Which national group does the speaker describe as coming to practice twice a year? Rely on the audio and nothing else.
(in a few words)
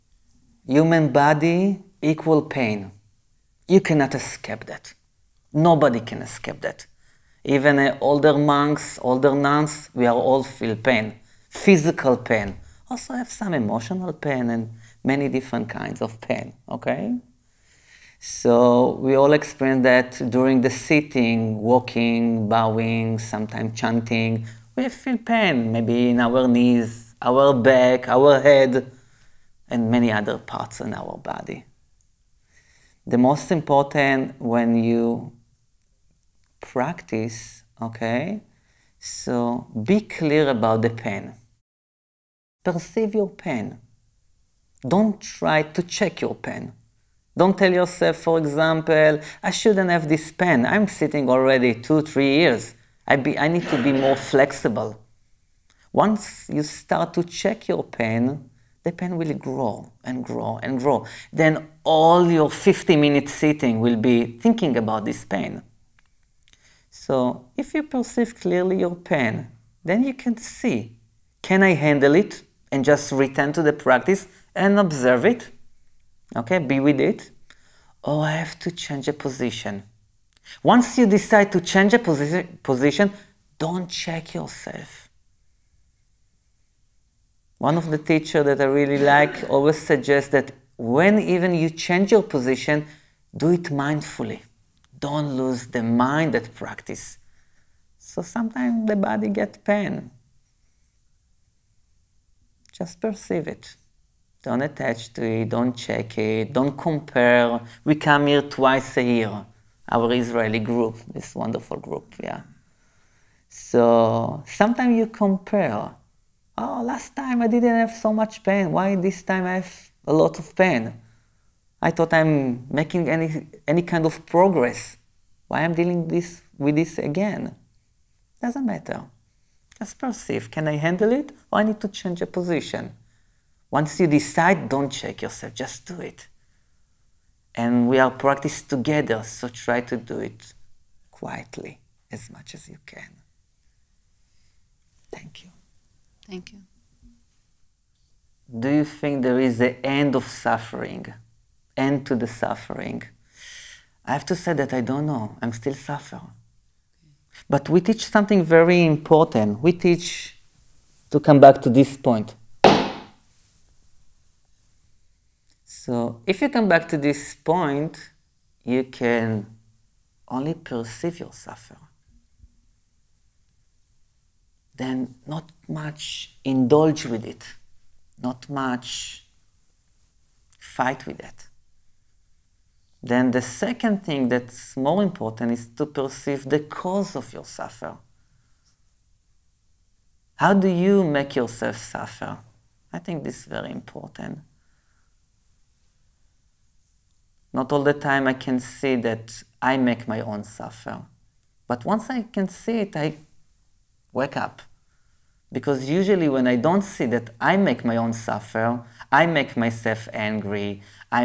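Israeli.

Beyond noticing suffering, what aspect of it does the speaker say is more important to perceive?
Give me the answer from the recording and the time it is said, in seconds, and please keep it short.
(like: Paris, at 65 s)
The cause, at 186 s.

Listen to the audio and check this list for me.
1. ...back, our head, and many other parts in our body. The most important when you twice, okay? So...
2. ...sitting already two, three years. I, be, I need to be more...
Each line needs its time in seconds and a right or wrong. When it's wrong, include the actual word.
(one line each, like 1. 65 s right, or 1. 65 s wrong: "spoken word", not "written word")
1. 27 s wrong: "practice", not "twice"
2. 50 s right.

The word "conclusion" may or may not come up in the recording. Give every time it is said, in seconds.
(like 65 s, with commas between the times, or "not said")
not said.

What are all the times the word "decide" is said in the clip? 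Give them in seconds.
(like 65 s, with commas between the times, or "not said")
81 s, 134 s.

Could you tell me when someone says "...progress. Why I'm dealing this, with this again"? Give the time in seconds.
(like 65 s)
124 s.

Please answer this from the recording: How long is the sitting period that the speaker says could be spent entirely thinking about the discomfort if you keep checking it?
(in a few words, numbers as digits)
50 minutes.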